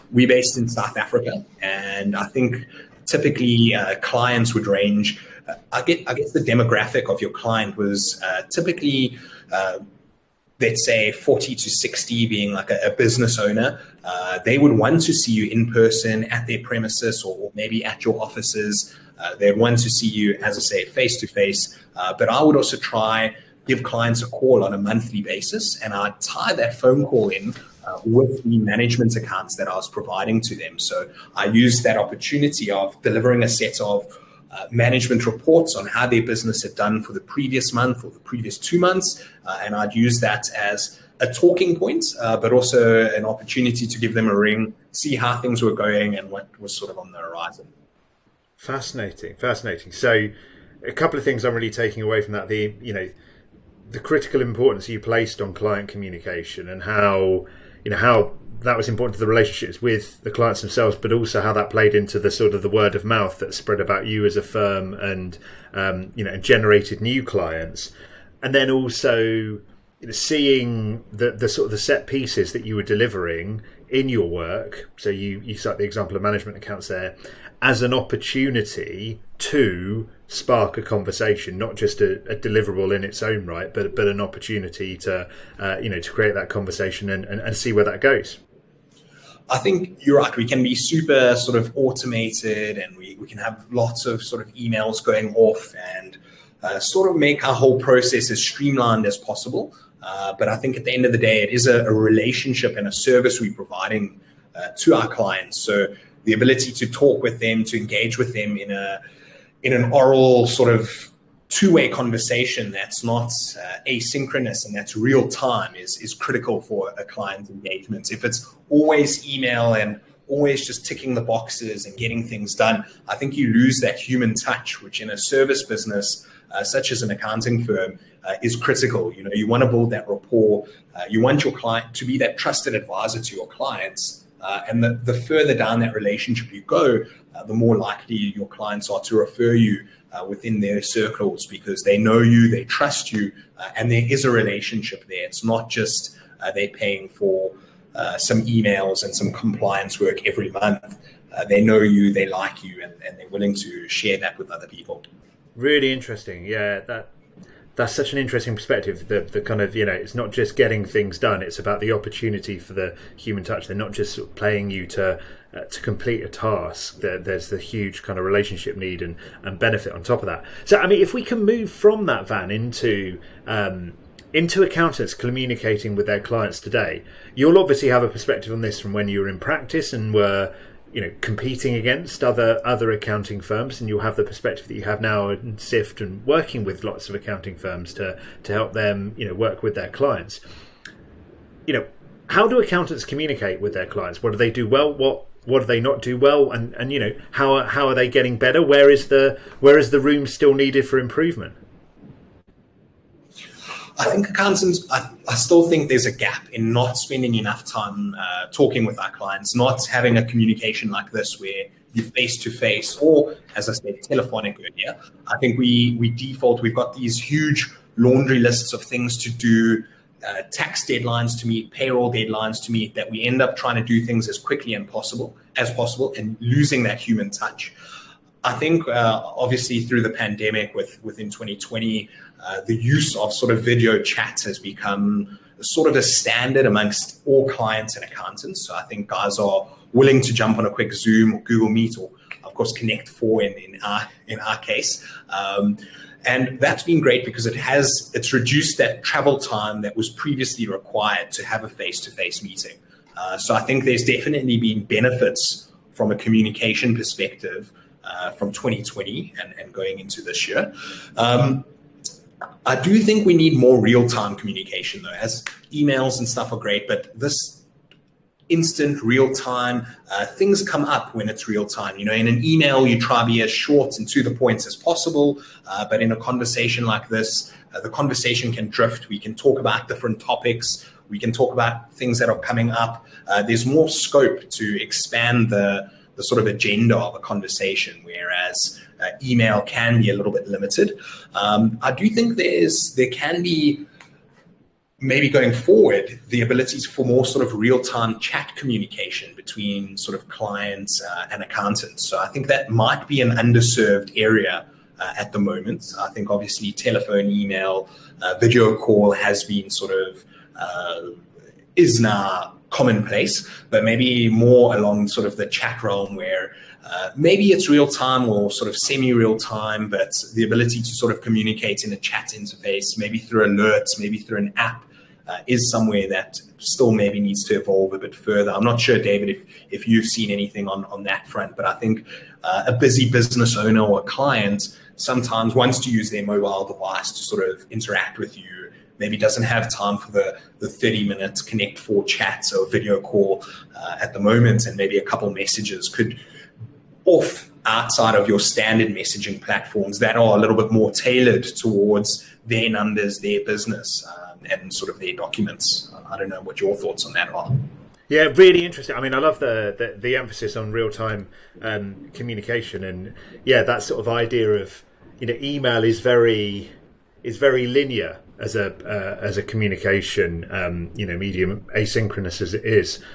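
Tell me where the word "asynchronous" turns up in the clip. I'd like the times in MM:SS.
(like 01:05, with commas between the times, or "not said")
01:53, 06:11.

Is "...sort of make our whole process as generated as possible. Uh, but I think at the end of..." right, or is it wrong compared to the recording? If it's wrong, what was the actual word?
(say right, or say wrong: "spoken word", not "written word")
wrong: "streamlined", not "generated".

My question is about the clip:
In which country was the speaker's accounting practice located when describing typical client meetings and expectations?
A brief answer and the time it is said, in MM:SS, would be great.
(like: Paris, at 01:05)
South Africa, at 00:00.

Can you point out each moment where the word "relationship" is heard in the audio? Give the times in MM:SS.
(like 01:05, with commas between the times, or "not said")
00:59, 01:41, 02:15, 02:24, 02:48.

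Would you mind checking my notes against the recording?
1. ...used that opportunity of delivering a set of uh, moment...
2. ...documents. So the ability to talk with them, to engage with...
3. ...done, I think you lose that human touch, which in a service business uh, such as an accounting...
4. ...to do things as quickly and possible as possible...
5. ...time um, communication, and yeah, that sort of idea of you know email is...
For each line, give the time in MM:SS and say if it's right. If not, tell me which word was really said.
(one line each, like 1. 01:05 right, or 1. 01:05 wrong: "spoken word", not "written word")
1. 00:31 wrong: "management", not "moment"
2. 01:45 wrong: "clients", not "documents"
3. 02:02 right
4. 03:43 right
5. 06:00 right.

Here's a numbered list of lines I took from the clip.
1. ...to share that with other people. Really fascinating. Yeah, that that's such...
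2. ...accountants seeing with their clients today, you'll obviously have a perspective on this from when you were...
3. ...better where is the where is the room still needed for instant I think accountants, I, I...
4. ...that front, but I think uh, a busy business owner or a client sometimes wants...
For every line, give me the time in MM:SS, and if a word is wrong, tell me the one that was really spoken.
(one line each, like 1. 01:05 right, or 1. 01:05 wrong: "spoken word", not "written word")
1. 02:33 wrong: "interesting", not "fascinating"
2. 02:54 wrong: "communicating", not "seeing"
3. 03:18 wrong: "improvement", not "instant"
4. 05:31 right.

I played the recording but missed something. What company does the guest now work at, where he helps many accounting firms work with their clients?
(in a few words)
Syft.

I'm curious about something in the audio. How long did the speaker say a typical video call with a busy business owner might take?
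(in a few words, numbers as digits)
30 minutes.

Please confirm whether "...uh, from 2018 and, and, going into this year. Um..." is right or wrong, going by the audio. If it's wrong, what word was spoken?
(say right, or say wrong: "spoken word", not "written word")
wrong: "2020", not "2018".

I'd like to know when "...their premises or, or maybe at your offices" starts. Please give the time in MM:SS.
00:16.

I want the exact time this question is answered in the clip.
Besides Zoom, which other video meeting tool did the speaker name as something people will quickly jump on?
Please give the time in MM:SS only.
04:01.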